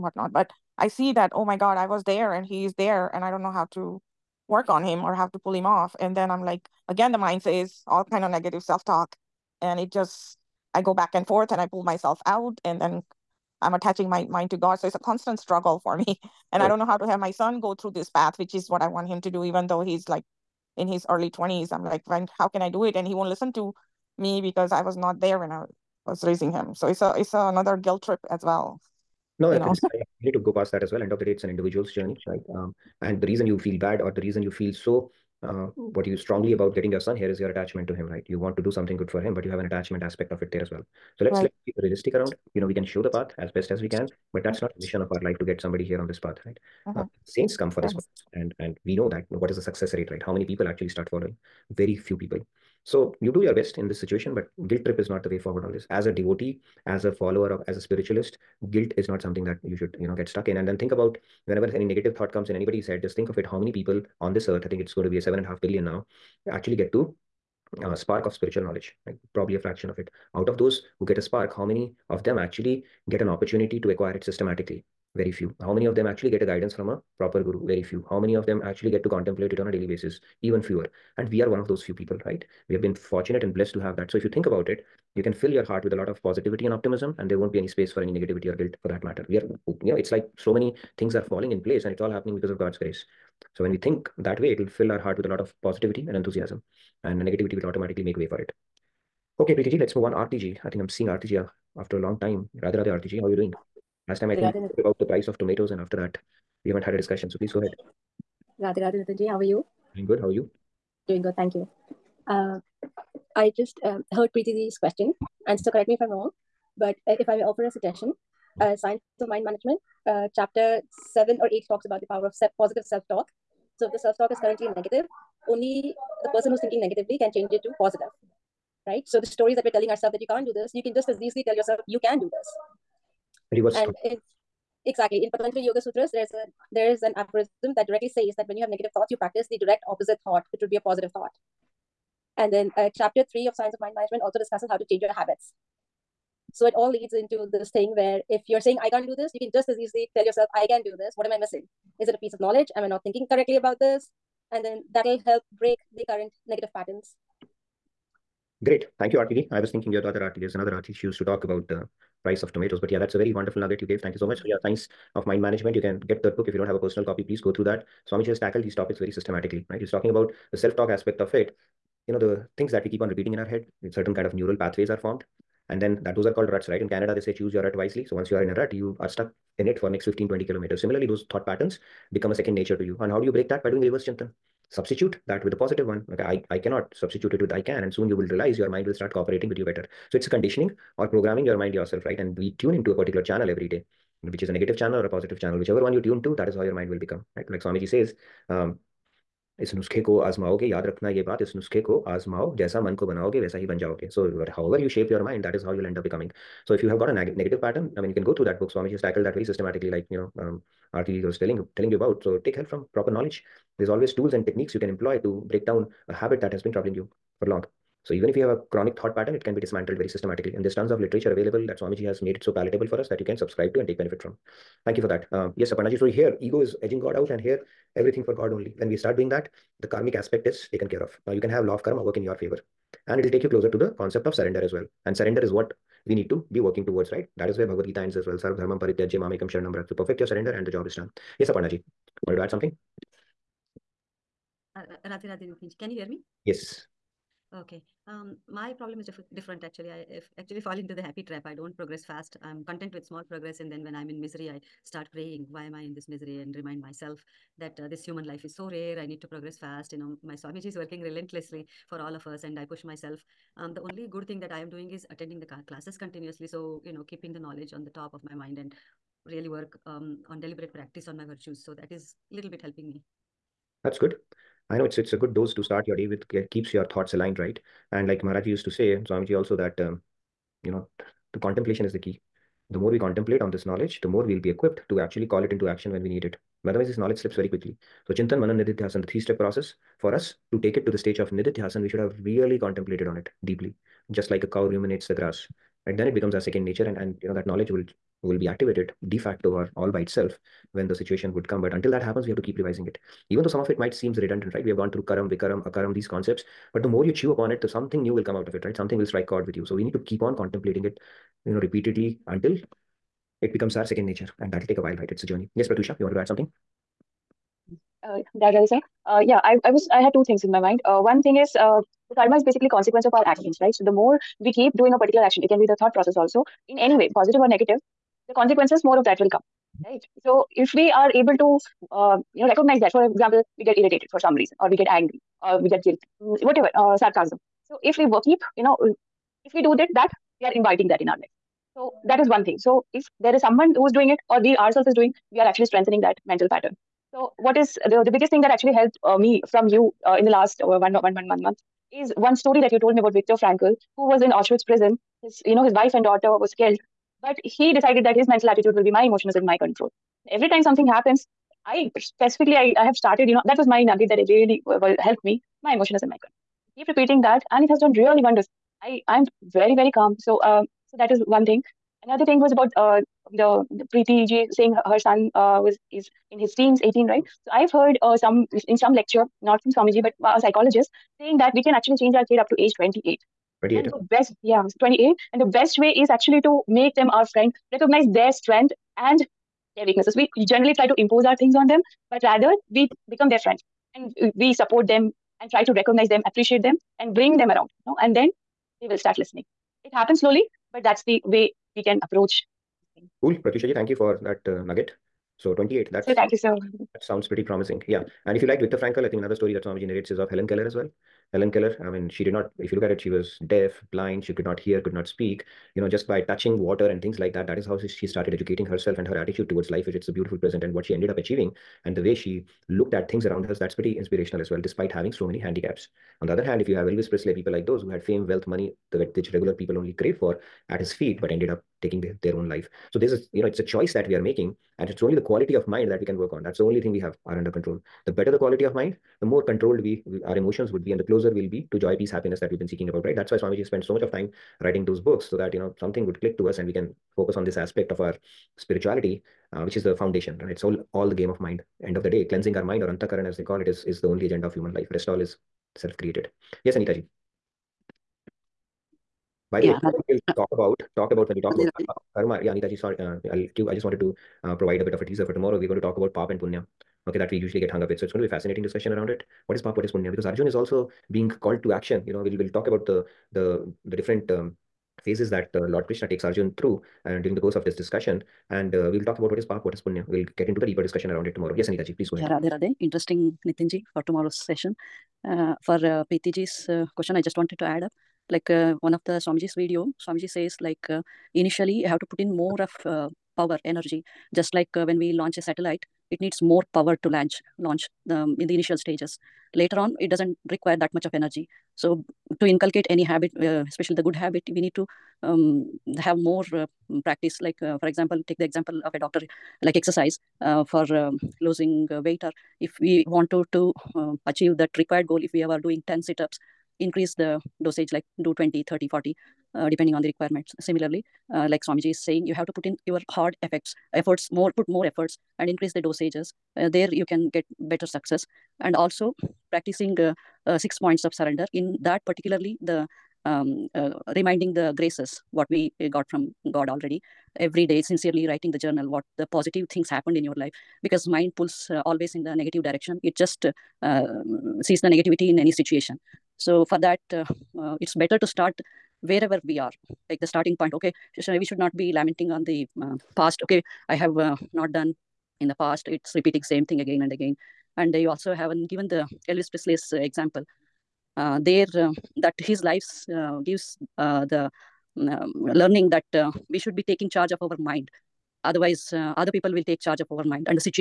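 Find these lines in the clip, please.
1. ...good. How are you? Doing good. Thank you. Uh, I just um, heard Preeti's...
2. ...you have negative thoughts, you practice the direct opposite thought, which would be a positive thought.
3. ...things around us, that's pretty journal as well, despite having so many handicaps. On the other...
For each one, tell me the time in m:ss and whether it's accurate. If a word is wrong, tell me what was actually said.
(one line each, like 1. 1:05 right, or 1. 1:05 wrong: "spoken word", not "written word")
1. 1:50 right
2. 2:18 right
3. 7:03 wrong: "inspirational", not "journal".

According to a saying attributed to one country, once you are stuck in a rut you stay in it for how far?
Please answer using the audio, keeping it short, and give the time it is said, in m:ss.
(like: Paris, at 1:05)
15-20 kilometers, at 3:00.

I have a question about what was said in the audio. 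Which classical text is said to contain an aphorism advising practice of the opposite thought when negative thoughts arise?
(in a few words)
Patanjali Yoga Sutras.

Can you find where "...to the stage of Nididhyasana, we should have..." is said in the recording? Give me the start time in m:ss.
4:50.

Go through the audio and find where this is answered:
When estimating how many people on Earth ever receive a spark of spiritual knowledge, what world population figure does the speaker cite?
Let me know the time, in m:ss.
1:05.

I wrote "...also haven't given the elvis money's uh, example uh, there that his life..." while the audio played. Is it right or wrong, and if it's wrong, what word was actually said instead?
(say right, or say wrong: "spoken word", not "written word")
wrong: "presley", not "money".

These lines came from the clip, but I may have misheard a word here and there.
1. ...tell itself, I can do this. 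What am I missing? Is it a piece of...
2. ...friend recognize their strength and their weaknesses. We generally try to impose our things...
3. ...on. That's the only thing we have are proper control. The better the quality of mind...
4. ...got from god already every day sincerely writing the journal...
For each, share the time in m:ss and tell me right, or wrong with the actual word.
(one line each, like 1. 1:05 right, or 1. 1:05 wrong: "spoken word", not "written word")
1. 2:30 wrong: "yourself", not "itself"
2. 6:27 right
3. 7:16 wrong: "under", not "proper"
4. 8:55 right.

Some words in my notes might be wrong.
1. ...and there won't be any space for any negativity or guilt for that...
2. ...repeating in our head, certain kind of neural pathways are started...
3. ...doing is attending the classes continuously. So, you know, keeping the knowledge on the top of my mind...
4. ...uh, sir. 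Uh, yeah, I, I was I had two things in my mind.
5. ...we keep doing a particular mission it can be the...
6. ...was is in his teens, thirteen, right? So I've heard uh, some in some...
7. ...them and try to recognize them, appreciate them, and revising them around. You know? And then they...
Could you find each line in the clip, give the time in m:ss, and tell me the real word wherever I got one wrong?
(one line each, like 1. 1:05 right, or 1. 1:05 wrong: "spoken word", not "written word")
1. 1:27 right
2. 2:53 wrong: "formed", not "started"
3. 4:24 right
4. 5:18 right
5. 5:24 wrong: "action", not "mission"
6. 6:15 wrong: "eighteen", not "thirteen"
7. 6:34 wrong: "bring", not "revising".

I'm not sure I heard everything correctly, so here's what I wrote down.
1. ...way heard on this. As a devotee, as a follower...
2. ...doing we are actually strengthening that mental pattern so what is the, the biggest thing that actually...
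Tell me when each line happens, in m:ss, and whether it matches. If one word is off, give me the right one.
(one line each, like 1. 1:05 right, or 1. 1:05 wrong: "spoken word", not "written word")
1. 0:55 wrong: "forward", not "heard"
2. 5:44 right.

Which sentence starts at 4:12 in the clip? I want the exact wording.
I'm content with small progress, and then when I'm in misery, I start praying.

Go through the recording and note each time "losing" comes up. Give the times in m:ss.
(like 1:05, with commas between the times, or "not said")
8:31.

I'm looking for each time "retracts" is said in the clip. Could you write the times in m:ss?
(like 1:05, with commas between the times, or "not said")
not said.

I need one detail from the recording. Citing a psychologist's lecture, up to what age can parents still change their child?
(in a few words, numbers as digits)
28.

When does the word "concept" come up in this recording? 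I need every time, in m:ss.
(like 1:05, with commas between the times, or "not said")
3:53, 5:06.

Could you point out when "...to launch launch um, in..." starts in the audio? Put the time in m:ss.
8:17.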